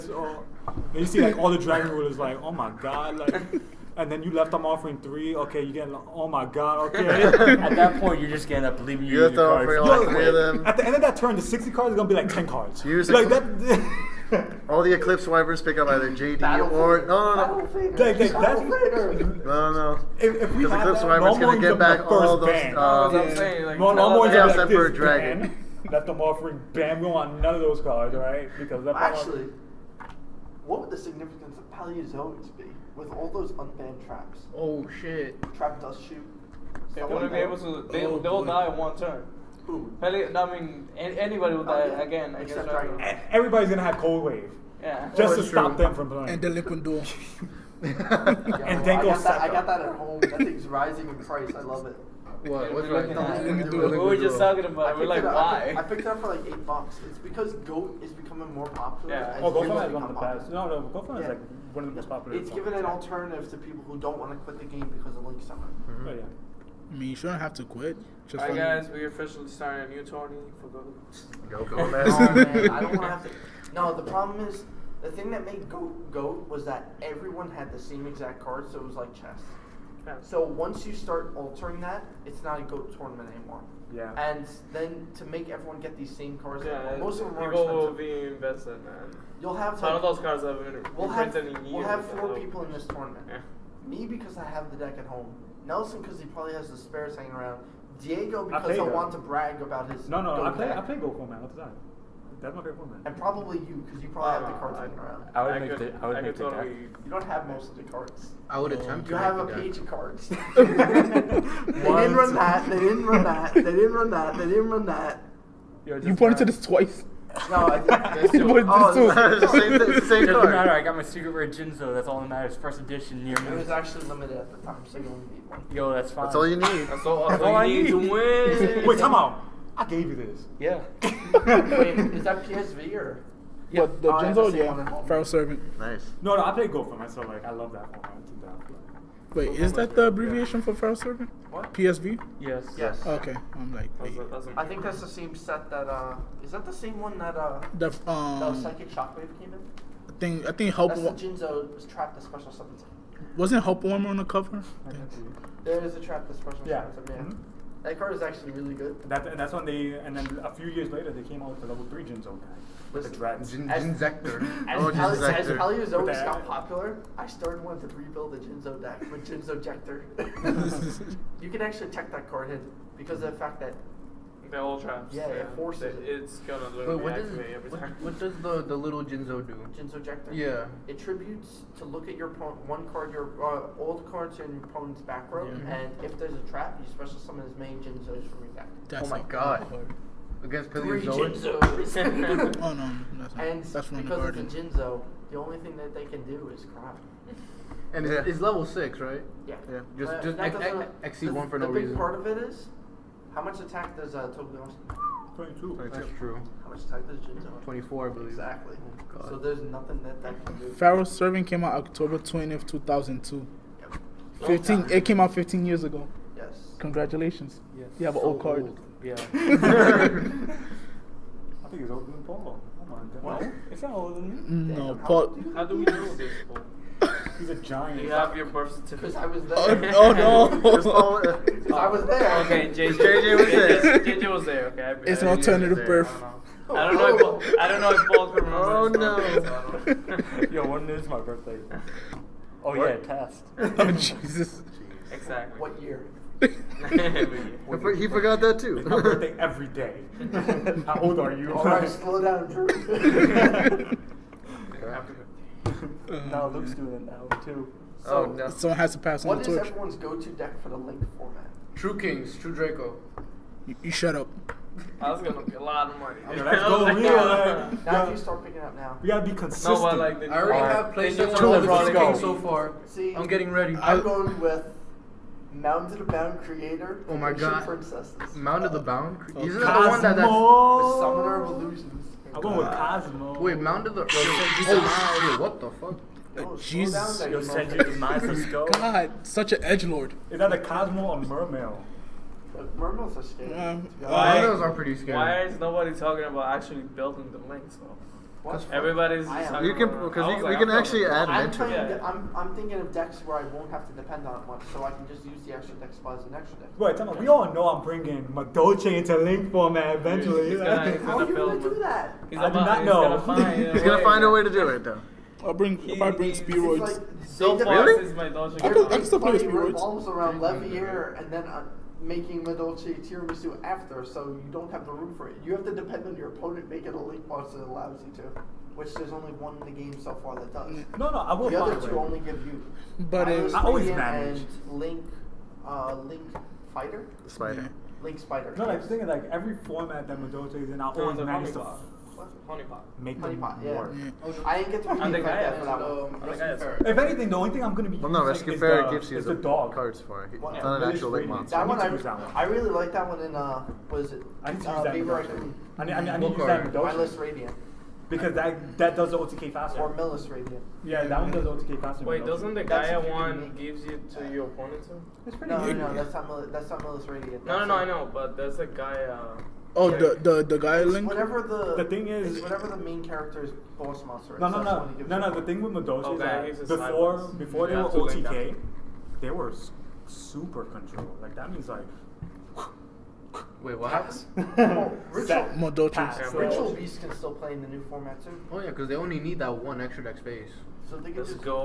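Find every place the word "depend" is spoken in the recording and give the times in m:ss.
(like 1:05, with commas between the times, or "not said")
5:03, 5:25.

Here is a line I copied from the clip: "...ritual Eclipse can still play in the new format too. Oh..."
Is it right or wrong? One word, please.
wrong.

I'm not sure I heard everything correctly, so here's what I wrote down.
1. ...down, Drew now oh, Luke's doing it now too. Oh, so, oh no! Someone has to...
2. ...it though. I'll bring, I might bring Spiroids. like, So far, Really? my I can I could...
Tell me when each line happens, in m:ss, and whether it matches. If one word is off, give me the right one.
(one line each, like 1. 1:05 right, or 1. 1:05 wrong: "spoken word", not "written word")
1. 4:12 right
2. 5:14 right.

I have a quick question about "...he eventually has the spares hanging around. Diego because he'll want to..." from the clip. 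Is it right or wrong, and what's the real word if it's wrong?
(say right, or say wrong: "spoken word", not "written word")
wrong: "probably", not "eventually".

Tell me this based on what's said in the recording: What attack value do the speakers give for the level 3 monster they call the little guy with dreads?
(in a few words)
22.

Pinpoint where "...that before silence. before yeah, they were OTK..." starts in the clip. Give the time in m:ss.
6:16.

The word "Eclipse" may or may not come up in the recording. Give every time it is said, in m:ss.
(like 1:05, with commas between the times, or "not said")
0:14, 0:20.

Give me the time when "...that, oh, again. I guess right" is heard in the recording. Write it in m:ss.
0:41.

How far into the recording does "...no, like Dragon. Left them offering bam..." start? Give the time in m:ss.
0:23.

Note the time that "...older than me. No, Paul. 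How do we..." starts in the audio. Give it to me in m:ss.
3:43.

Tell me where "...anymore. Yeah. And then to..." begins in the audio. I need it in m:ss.
1:23.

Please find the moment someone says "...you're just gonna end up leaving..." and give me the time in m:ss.
0:08.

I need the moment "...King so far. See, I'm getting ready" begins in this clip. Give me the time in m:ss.
4:31.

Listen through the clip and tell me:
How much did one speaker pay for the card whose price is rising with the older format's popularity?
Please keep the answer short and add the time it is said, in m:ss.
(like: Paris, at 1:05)
8 bucks, at 0:56.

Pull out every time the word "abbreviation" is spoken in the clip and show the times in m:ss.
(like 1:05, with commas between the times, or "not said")
2:20.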